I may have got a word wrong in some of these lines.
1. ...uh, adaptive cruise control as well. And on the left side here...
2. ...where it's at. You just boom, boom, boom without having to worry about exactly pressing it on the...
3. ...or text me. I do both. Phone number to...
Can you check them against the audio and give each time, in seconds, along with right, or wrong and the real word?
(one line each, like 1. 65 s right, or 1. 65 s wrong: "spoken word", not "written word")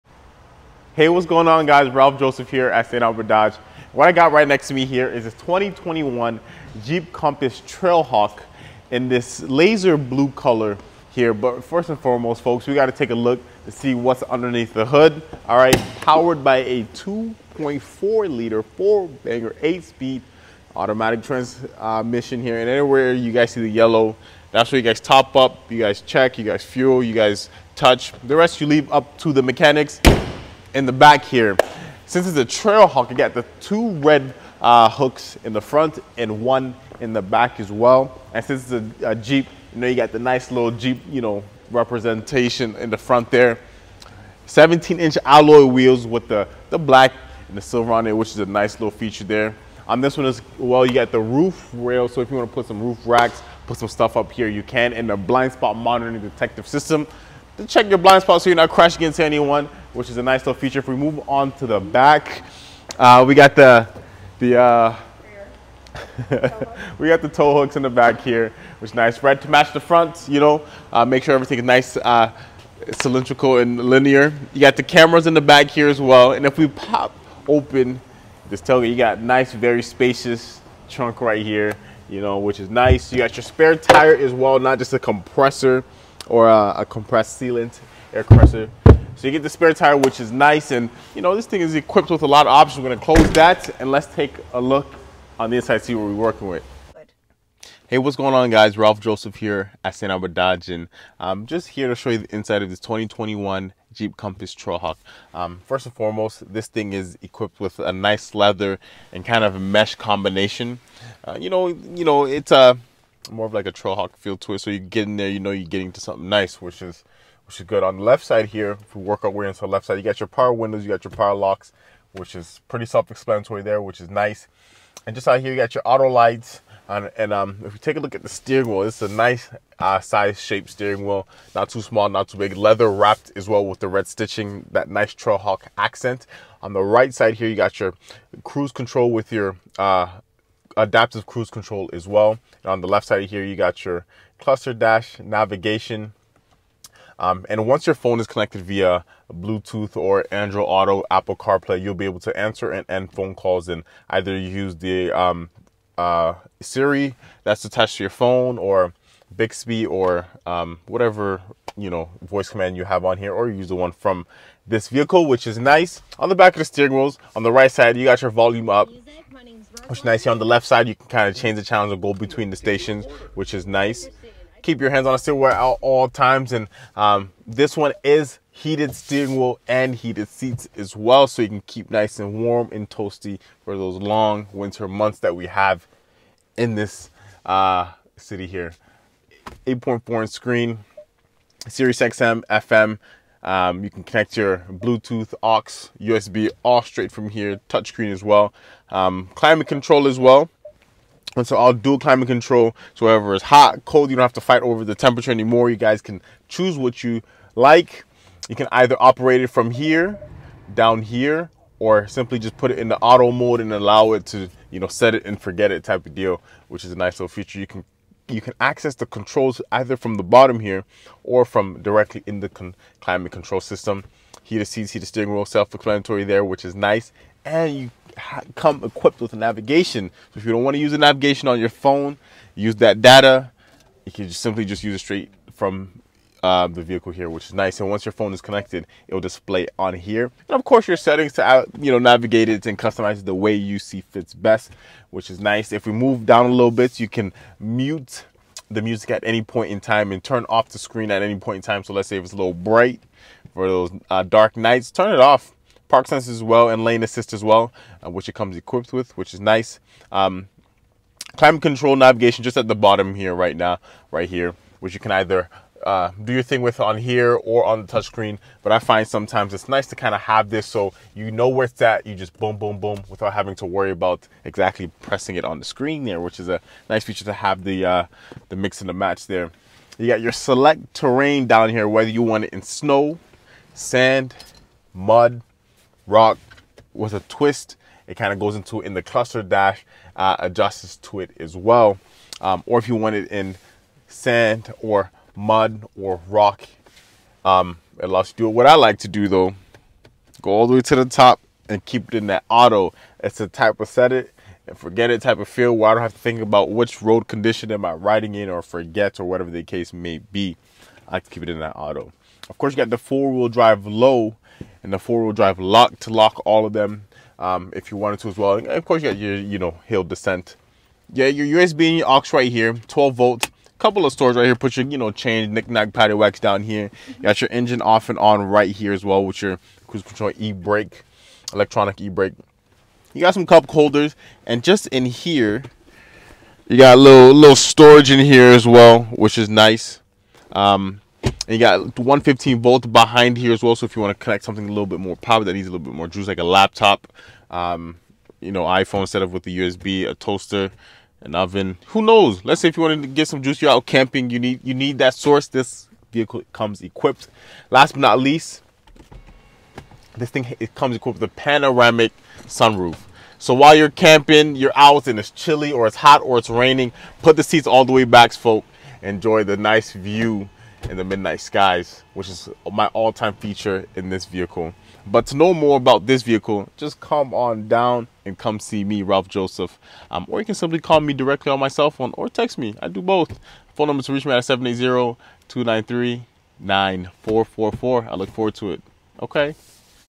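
1. 139 s right
2. 271 s right
3. 382 s right.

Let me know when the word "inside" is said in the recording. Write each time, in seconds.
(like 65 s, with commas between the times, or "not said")
95 s, 102 s.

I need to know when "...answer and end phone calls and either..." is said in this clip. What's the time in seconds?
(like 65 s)
152 s.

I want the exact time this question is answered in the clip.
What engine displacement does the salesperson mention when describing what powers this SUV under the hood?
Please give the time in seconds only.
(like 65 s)
16 s.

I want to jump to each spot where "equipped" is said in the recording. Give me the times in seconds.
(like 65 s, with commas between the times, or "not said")
91 s, 107 s, 228 s, 258 s, 356 s, 360 s.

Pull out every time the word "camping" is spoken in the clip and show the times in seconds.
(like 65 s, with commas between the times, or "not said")
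353 s, 363 s.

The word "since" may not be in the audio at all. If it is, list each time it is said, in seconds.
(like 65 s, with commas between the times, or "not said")
32 s, 38 s.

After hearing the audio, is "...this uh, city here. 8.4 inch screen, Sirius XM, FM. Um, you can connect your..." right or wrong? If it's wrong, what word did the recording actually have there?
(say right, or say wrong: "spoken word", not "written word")
right.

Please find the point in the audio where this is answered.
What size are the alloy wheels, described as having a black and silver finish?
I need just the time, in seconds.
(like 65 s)
44 s.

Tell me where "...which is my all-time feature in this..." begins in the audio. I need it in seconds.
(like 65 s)
372 s.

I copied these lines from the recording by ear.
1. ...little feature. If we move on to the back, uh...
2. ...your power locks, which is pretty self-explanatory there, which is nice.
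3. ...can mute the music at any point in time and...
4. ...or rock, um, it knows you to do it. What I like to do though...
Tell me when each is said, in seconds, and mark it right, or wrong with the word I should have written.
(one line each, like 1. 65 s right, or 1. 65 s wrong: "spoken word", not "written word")
1. 60 s right
2. 121 s right
3. 247 s right
4. 295 s wrong: "allows", not "knows".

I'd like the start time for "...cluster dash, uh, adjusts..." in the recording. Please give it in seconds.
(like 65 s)
289 s.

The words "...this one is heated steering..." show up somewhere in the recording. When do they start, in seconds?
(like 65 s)
177 s.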